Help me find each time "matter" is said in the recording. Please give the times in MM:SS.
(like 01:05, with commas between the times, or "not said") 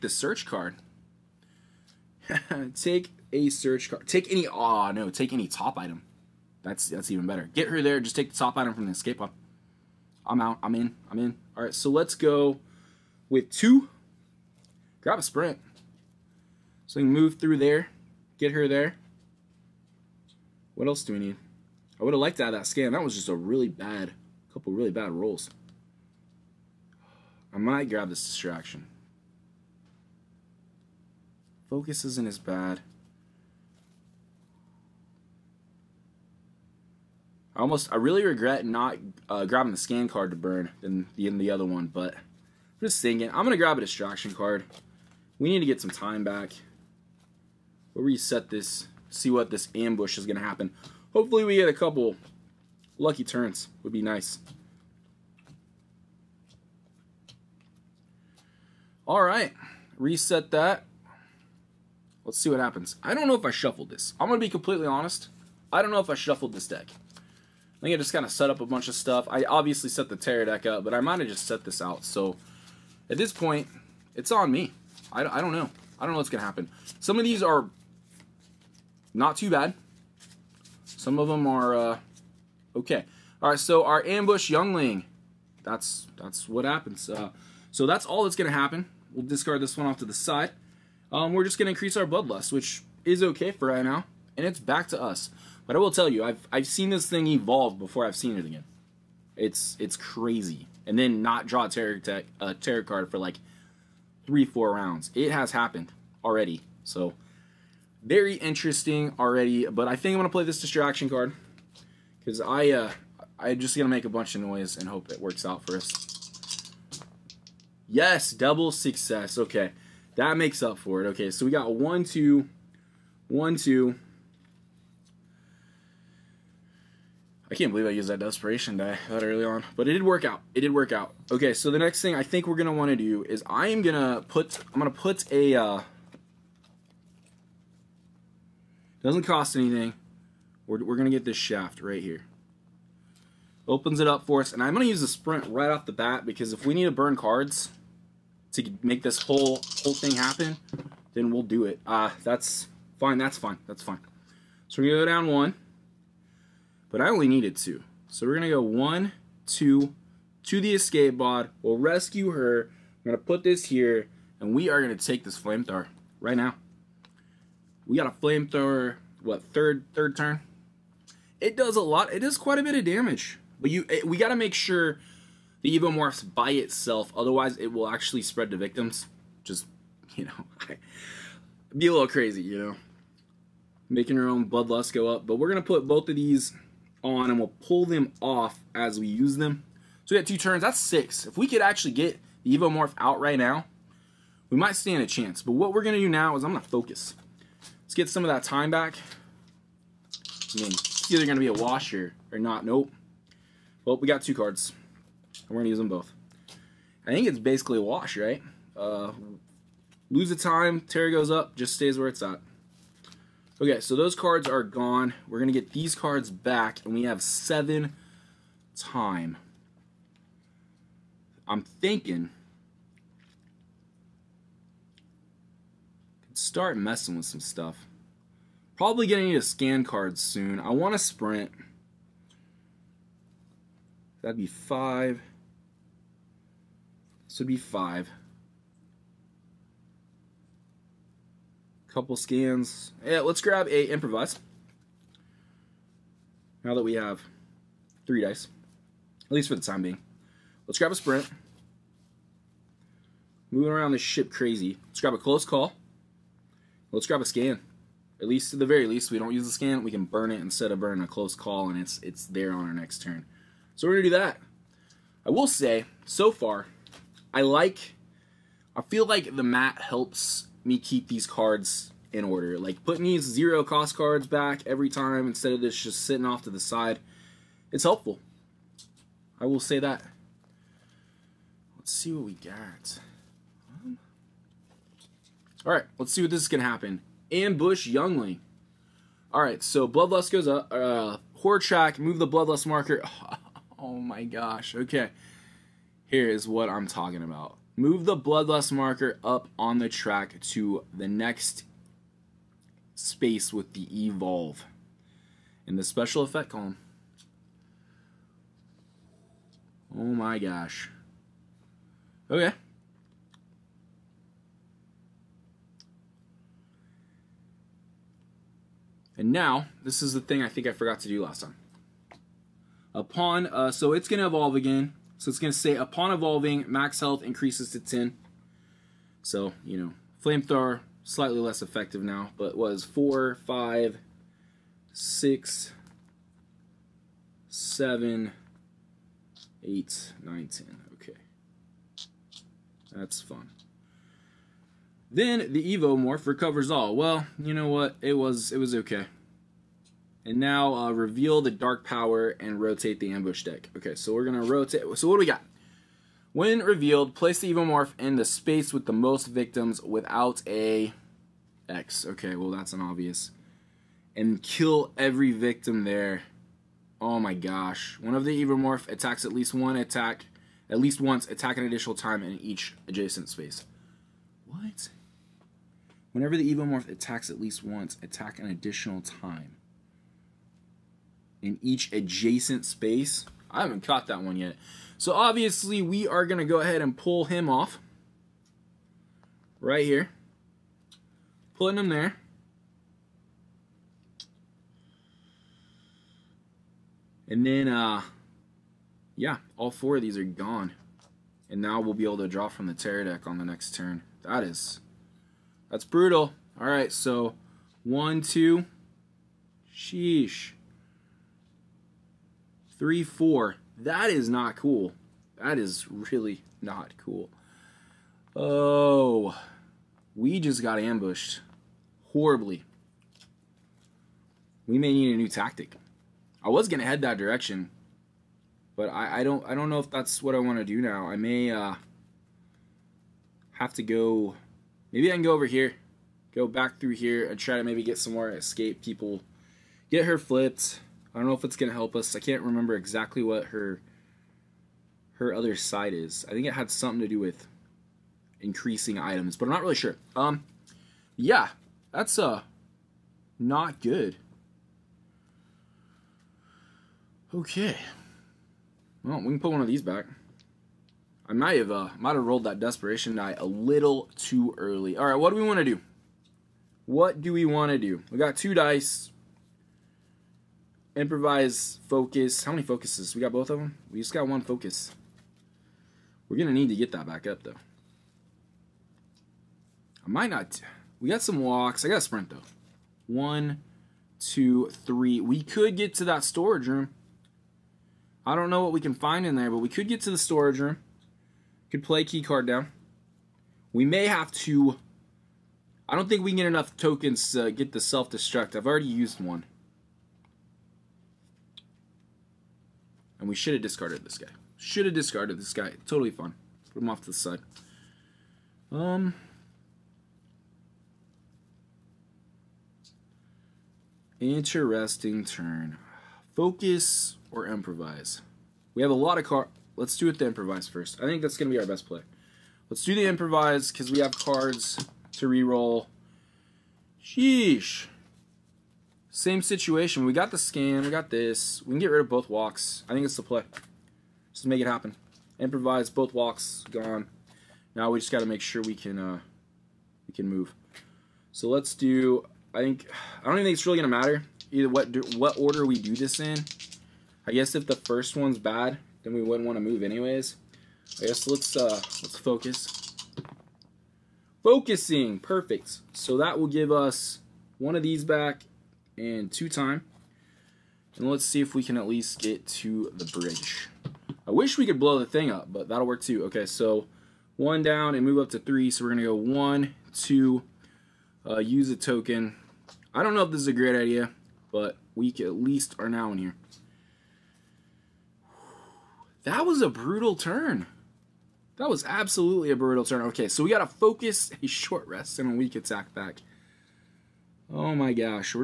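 09:03.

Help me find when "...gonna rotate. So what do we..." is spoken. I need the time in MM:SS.
05:54.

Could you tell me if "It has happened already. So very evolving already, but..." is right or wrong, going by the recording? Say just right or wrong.
wrong.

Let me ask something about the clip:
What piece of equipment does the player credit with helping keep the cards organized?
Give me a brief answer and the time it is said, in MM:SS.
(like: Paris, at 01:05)
the mat, at 04:29.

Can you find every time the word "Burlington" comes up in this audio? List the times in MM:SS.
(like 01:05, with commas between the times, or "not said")
not said.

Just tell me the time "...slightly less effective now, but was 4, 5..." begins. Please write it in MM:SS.
05:31.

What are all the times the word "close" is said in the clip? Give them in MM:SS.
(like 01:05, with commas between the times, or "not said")
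04:15, 04:21.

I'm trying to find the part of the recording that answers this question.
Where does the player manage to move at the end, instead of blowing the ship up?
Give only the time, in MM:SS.
09:22.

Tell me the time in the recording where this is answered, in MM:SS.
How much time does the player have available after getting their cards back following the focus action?
03:36.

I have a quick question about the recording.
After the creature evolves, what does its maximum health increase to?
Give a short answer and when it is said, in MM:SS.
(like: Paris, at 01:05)
10, at 05:26.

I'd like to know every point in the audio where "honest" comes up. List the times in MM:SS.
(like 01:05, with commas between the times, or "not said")
01:04.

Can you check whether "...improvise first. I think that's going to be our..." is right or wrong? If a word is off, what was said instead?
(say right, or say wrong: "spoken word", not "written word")
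right.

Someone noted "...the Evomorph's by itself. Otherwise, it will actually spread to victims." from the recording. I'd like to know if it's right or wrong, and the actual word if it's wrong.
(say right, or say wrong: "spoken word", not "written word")
right.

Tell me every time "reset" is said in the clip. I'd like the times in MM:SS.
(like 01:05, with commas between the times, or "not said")
00:48, 00:59.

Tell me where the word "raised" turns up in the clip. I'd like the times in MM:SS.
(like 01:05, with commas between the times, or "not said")
not said.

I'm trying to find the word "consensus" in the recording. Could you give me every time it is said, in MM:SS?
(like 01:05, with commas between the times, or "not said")
not said.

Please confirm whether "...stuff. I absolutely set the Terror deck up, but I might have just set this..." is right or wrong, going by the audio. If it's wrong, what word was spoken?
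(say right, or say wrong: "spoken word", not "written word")
wrong: "obviously", not "absolutely".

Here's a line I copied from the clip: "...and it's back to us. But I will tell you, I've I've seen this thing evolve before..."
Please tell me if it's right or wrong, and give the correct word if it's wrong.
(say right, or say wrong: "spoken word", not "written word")
right.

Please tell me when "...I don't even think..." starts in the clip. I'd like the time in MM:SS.
09:03.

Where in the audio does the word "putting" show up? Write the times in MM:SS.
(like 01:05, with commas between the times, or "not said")
04:32, 06:31.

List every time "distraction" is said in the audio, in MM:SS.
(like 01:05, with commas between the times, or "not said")
00:28, 00:43, 01:50.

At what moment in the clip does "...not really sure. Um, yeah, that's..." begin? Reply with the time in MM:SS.
07:29.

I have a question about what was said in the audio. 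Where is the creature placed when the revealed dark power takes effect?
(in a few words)
space with the most victims.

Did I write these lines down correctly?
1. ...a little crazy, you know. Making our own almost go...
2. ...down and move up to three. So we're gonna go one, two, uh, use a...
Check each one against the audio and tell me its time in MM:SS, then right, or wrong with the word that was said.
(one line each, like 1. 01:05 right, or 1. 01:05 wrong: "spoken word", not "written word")
1. 03:01 wrong: "bloodlust", not "almost"
2. 09:27 right.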